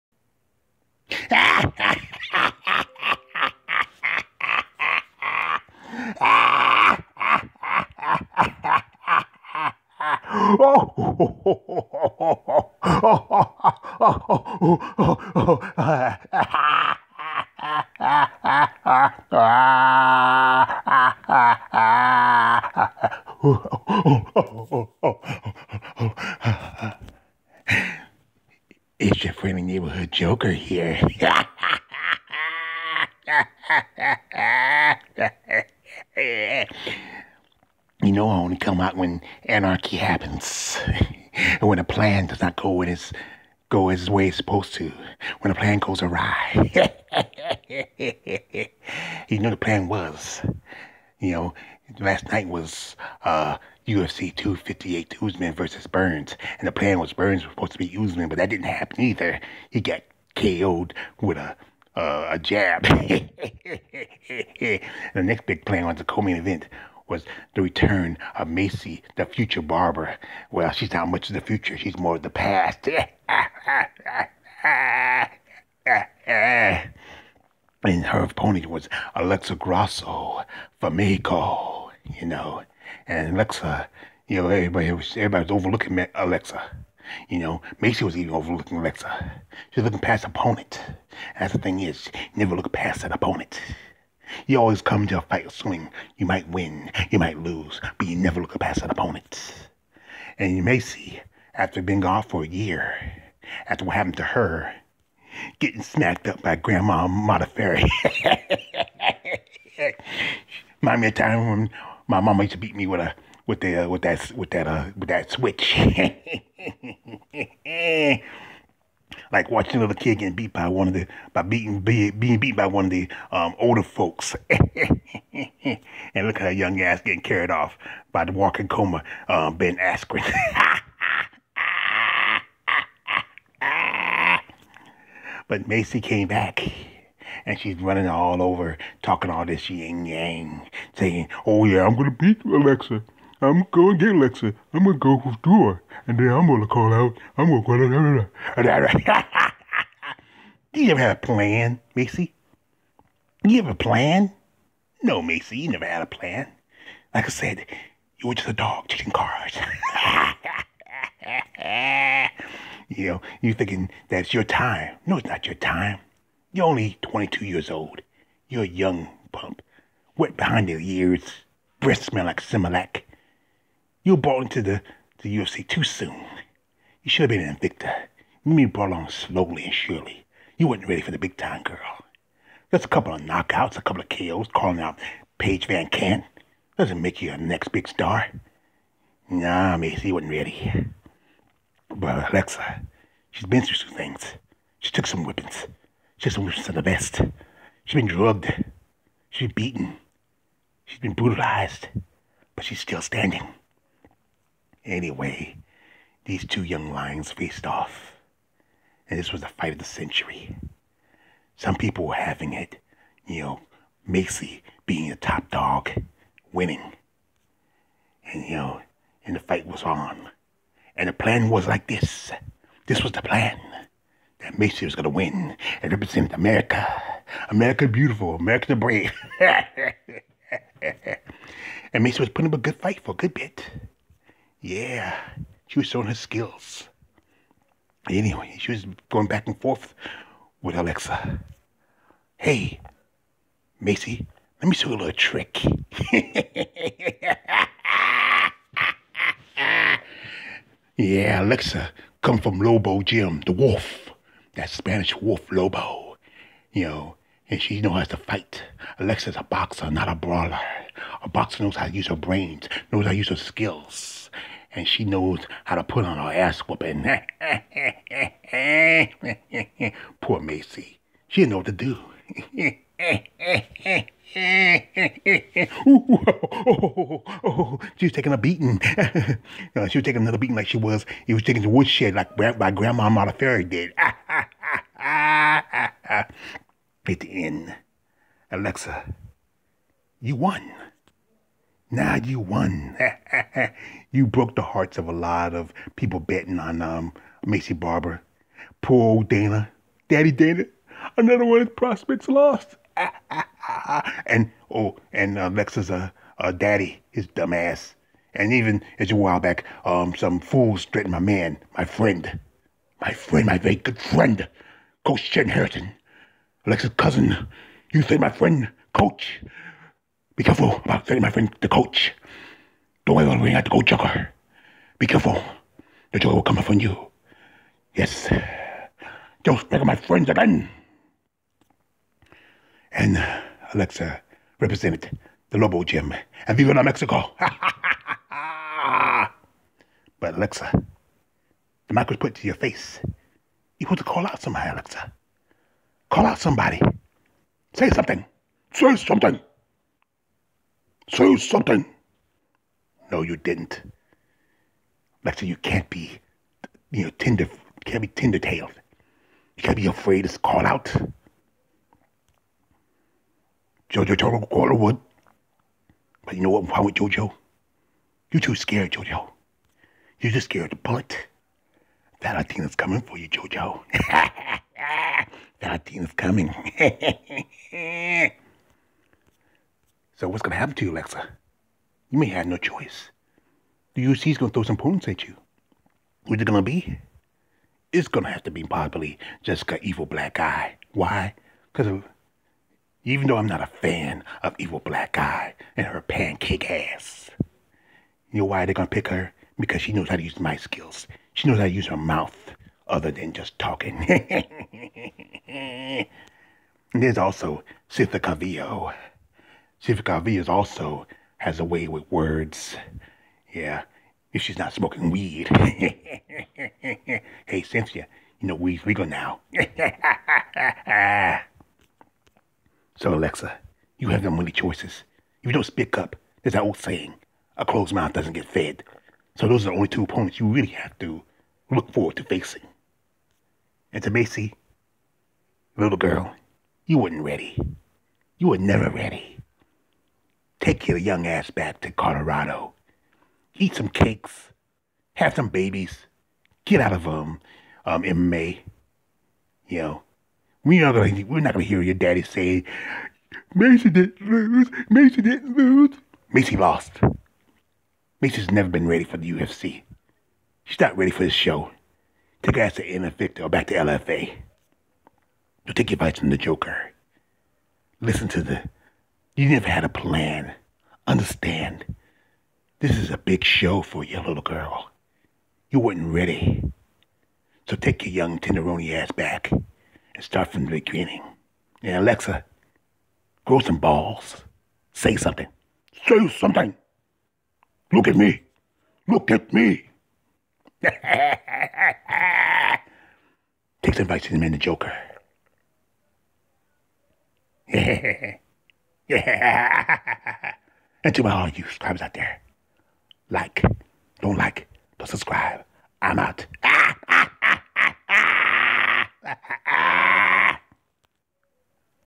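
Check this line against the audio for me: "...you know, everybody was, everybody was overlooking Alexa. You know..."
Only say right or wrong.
right.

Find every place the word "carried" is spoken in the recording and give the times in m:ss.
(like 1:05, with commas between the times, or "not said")
2:07.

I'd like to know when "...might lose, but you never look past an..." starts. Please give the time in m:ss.
1:37.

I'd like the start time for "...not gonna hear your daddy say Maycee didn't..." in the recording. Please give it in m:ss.
7:31.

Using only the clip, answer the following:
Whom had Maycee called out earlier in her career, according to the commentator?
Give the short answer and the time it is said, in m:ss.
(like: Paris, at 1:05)
Paige VanZant, at 3:05.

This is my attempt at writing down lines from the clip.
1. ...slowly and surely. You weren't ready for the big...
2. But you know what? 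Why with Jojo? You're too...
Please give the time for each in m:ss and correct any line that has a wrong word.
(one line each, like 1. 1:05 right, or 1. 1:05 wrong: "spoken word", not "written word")
1. 2:59 right
2. 6:06 right.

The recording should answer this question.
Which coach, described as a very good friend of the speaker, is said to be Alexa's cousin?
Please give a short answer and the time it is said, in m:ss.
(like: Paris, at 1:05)
Chen Harrington, at 5:15.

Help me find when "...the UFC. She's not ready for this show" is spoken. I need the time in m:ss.
7:39.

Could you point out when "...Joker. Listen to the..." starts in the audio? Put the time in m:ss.
7:46.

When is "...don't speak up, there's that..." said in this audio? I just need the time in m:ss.
7:05.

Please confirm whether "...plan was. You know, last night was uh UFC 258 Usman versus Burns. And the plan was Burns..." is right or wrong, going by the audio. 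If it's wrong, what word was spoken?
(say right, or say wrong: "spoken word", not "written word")
right.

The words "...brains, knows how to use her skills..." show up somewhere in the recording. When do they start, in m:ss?
4:22.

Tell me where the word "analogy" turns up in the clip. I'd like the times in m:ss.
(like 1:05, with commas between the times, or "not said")
not said.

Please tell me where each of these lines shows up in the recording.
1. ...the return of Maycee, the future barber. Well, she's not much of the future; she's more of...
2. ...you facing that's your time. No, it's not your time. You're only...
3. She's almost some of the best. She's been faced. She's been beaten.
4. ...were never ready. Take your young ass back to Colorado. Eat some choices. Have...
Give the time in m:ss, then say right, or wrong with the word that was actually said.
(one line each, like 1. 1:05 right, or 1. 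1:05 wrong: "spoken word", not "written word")
1. 1:07 right
2. 2:43 wrong: "thinking", not "facing"
3. 3:16 wrong: "drugged", not "faced"
4. 7:18 wrong: "cakes", not "choices".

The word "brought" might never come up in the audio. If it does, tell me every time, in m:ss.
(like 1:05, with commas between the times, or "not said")
2:54, 2:58.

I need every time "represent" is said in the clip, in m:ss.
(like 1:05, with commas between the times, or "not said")
3:45, 5:34.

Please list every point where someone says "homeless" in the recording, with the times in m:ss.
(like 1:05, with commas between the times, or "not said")
not said.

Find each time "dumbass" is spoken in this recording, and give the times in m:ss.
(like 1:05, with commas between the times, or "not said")
5:07.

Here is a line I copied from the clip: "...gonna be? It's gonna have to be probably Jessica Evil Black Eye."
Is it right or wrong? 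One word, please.
right.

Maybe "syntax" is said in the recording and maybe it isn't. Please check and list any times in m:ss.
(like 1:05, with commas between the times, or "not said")
not said.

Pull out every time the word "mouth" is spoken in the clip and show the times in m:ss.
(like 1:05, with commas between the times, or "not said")
6:41, 7:07.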